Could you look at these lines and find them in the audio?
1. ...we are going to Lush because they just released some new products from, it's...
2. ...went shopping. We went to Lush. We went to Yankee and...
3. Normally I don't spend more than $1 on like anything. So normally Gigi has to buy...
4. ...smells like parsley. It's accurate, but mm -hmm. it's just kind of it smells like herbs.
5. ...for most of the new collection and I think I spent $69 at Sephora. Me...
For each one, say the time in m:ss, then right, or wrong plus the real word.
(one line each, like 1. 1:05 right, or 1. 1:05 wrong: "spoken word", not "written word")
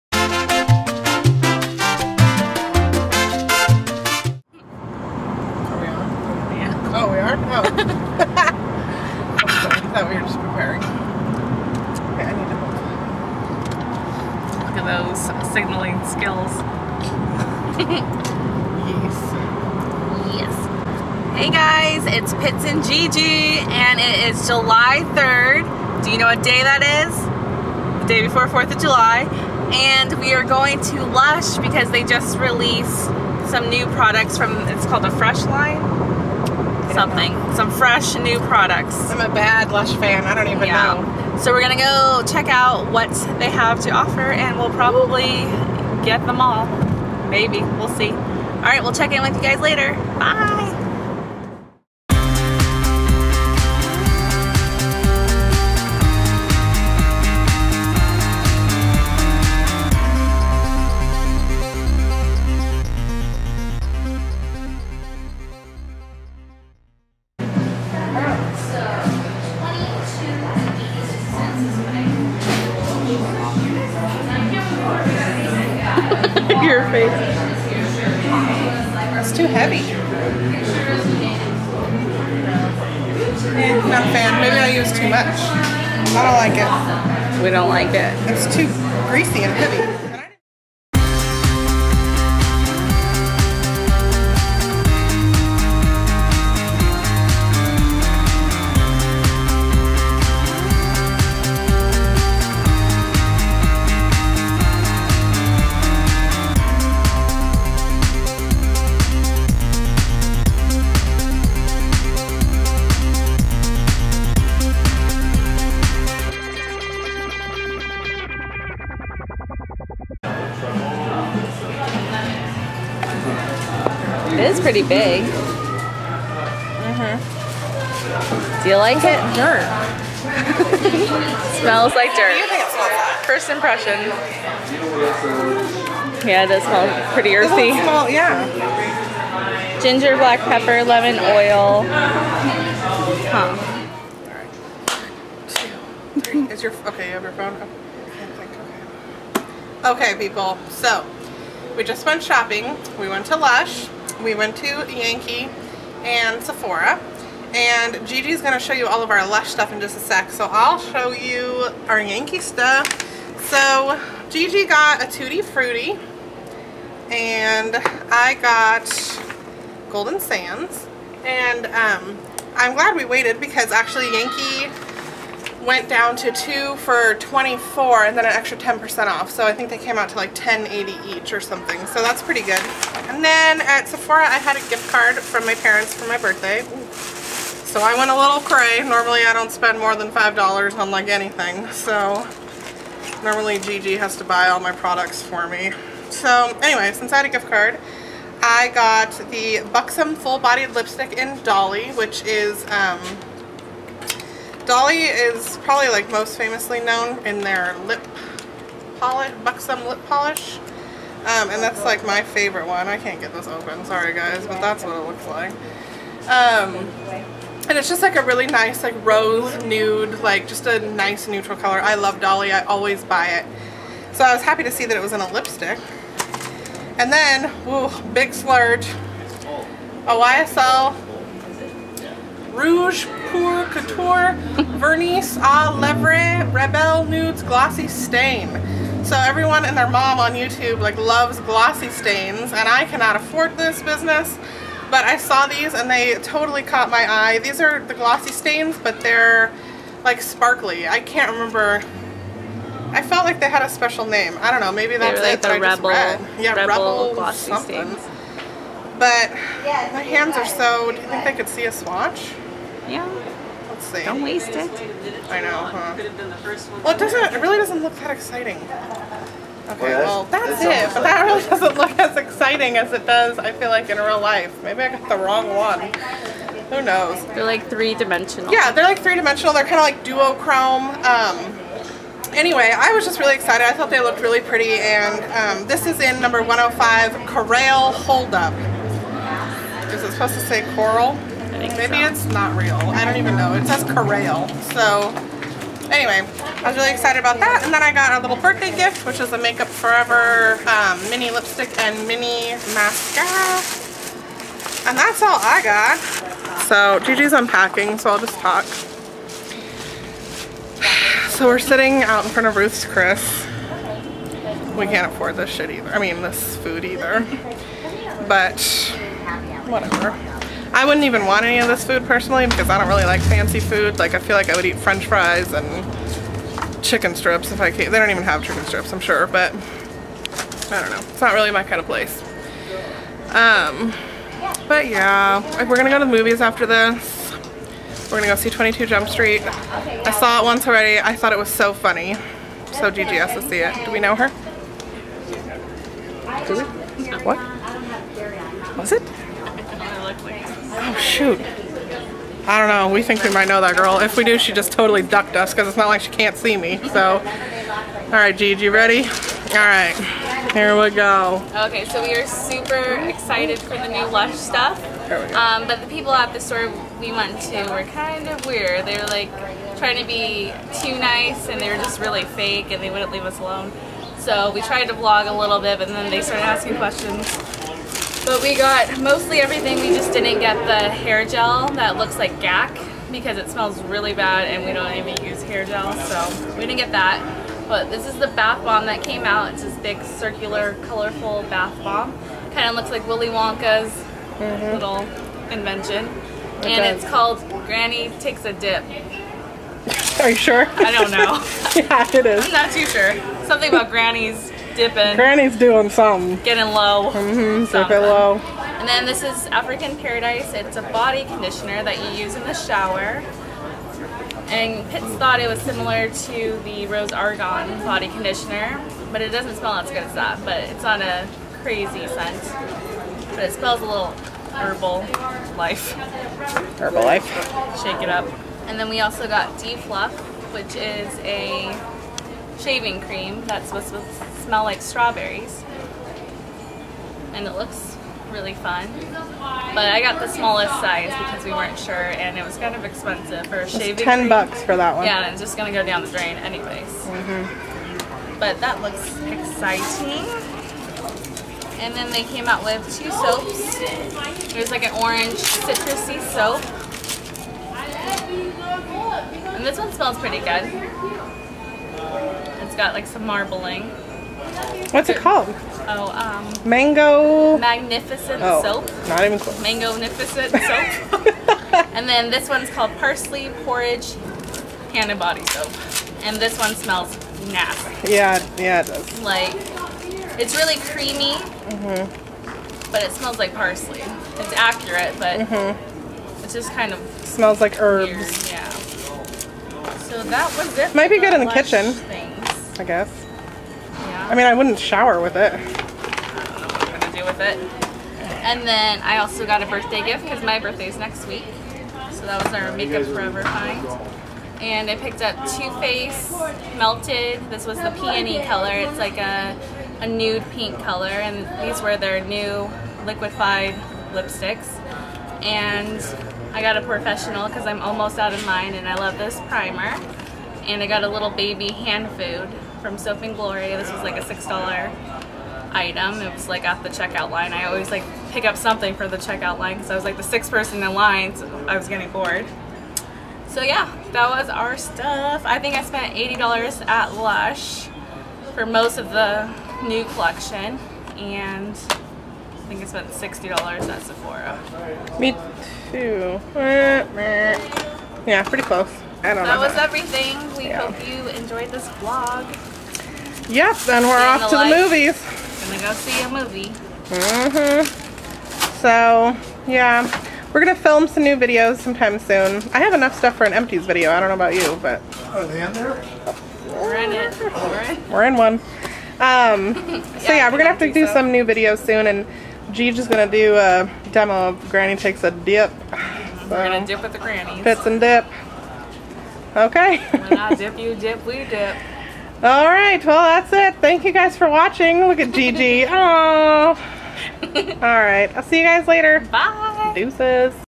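1. 0:30 right
2. 2:32 right
3. 3:08 wrong: "5", not "1"
4. 8:03 right
5. 8:58 wrong: "60", not "69".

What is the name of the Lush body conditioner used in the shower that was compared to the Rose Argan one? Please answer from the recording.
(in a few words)
African Paradise.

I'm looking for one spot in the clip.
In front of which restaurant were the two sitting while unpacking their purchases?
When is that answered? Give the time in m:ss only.
5:12.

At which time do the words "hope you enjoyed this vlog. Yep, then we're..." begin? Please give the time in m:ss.
9:10.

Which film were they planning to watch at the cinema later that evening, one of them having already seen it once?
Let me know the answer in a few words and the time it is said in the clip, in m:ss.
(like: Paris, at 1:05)
22 Jump Street, at 5:38.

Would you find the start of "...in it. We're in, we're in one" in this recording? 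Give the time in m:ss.
9:26.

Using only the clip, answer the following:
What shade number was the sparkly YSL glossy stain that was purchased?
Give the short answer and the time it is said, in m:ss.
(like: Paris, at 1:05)
105, at 4:46.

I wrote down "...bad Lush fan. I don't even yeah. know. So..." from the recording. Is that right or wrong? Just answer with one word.
right.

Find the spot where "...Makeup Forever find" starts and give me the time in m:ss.
8:22.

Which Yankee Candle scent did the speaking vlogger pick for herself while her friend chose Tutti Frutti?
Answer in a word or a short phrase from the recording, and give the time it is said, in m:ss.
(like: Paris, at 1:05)
Golden Sands, at 2:49.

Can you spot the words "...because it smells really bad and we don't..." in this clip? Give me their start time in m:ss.
6:23.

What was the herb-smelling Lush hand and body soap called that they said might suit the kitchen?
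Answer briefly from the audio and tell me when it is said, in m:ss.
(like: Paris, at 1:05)
Parsley Porridge, at 7:52.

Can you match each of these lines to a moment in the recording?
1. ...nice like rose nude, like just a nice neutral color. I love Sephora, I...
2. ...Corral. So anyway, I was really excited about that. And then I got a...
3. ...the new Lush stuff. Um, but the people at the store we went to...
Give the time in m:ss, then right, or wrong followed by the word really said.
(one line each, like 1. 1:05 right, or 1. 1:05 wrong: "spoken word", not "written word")
1. 3:38 wrong: "Dolly", not "Sephora"
2. 4:53 right
3. 6:03 right.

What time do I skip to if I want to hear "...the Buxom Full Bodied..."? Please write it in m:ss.
3:19.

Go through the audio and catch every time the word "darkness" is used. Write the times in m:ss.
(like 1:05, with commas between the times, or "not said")
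not said.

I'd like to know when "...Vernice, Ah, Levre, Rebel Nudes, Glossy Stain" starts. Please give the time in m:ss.
3:54.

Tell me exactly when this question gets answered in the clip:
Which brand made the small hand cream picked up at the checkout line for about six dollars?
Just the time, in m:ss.
8:42.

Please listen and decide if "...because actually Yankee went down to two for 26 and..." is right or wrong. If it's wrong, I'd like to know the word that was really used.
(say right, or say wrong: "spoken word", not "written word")
wrong: "24", not "26".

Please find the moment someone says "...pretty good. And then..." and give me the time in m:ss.
3:02.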